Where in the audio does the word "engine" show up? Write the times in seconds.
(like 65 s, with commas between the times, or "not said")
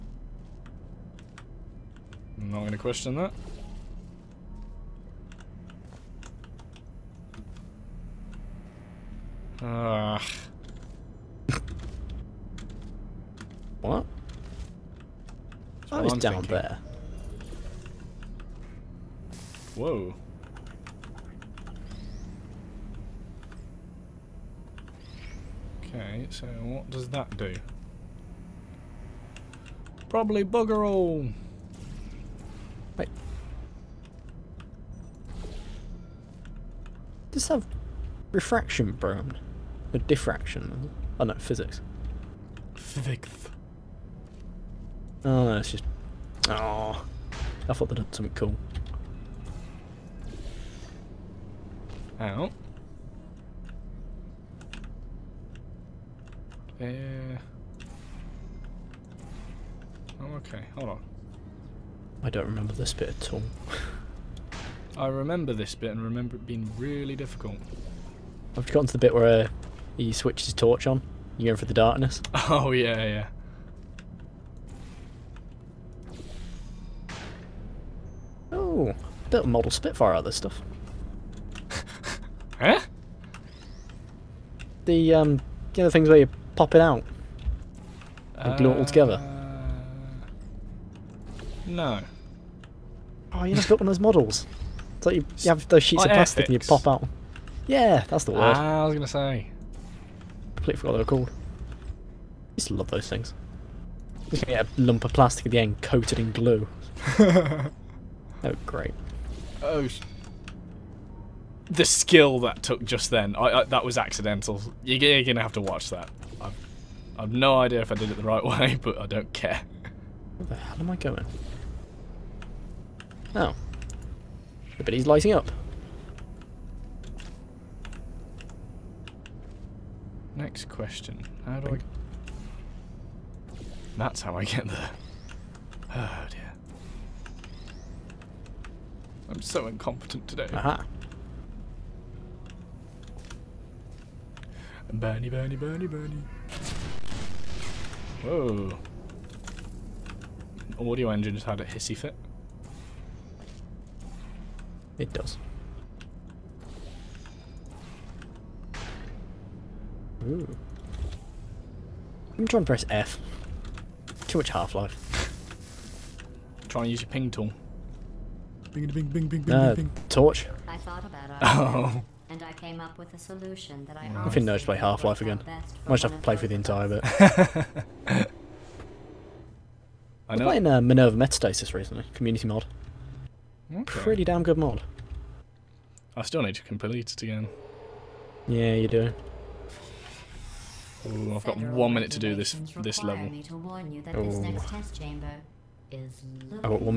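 151 s.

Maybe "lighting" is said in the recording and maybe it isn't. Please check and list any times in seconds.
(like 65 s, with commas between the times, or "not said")
125 s.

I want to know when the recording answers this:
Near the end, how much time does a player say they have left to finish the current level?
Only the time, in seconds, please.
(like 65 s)
191 s.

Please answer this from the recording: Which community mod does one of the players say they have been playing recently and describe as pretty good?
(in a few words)
Minerva Metastasis.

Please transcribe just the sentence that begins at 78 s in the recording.
Oh, bit of model Spitfire out of this stuff.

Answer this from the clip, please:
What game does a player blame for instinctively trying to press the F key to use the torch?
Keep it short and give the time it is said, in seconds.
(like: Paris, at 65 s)
Half-Life, at 164 s.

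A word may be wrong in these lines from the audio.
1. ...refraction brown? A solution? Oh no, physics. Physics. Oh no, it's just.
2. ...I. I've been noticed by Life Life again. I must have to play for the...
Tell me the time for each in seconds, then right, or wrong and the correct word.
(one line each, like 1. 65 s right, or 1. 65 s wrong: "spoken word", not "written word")
1. 38 s wrong: "diffraction", not "solution"
2. 173 s wrong: "Half", not "Life".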